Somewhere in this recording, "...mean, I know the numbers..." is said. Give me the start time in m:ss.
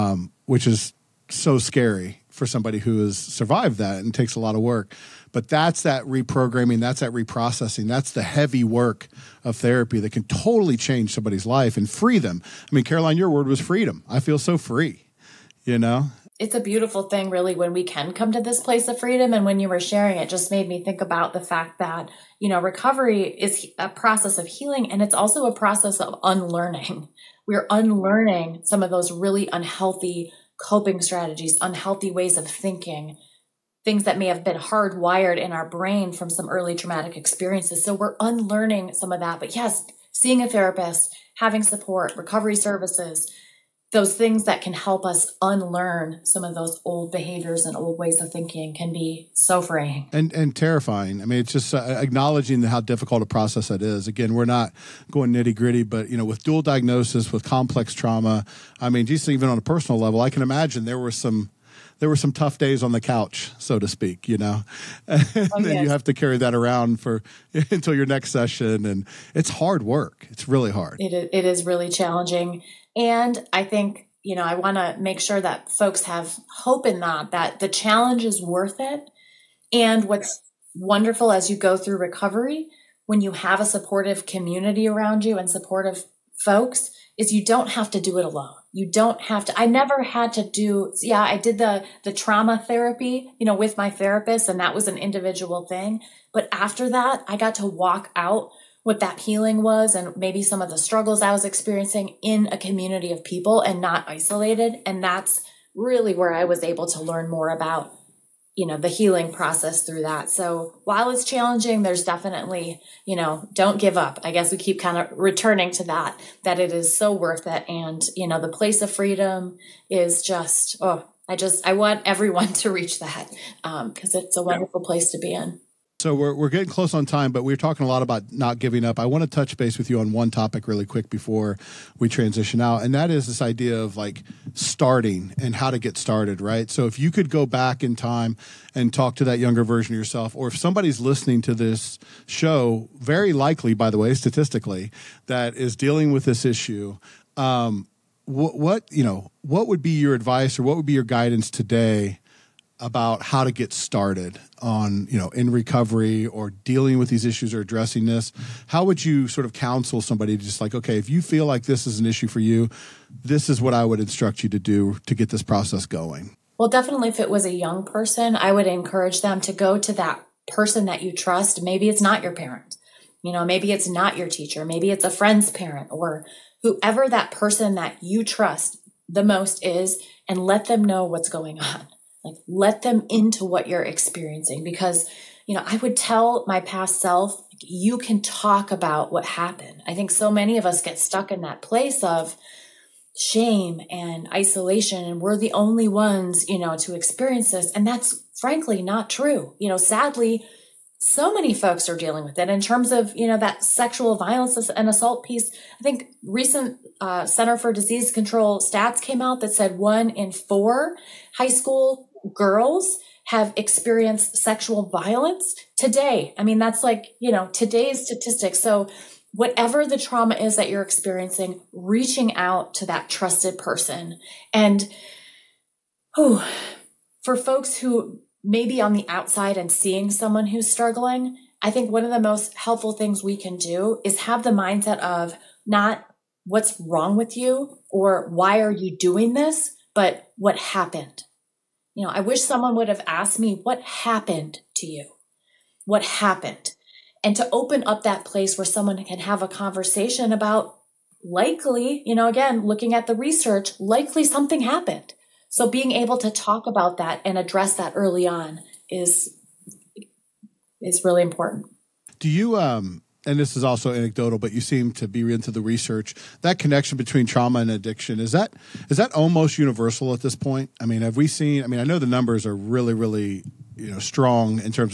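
4:31.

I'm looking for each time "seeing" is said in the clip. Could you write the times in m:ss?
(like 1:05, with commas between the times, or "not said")
0:40, 3:49.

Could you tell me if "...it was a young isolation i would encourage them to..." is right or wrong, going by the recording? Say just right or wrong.
wrong.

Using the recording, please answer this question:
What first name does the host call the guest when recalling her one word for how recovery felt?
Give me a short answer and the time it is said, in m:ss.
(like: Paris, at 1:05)
Caroline, at 0:12.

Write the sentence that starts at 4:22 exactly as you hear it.
Do you um and this is also anecdotal, but you seem to be into the research.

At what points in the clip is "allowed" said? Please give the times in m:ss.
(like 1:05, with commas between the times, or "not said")
not said.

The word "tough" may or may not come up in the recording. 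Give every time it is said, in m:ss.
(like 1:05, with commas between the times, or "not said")
1:02.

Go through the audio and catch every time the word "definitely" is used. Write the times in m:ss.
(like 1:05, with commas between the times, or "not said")
1:52, 2:46.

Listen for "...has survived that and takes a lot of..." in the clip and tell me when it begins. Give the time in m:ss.
0:03.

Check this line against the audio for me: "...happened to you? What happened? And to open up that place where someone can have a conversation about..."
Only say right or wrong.
right.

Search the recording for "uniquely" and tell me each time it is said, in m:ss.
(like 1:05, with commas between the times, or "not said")
not said.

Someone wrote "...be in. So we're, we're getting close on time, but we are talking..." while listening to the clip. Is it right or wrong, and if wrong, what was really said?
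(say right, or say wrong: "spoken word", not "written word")
right.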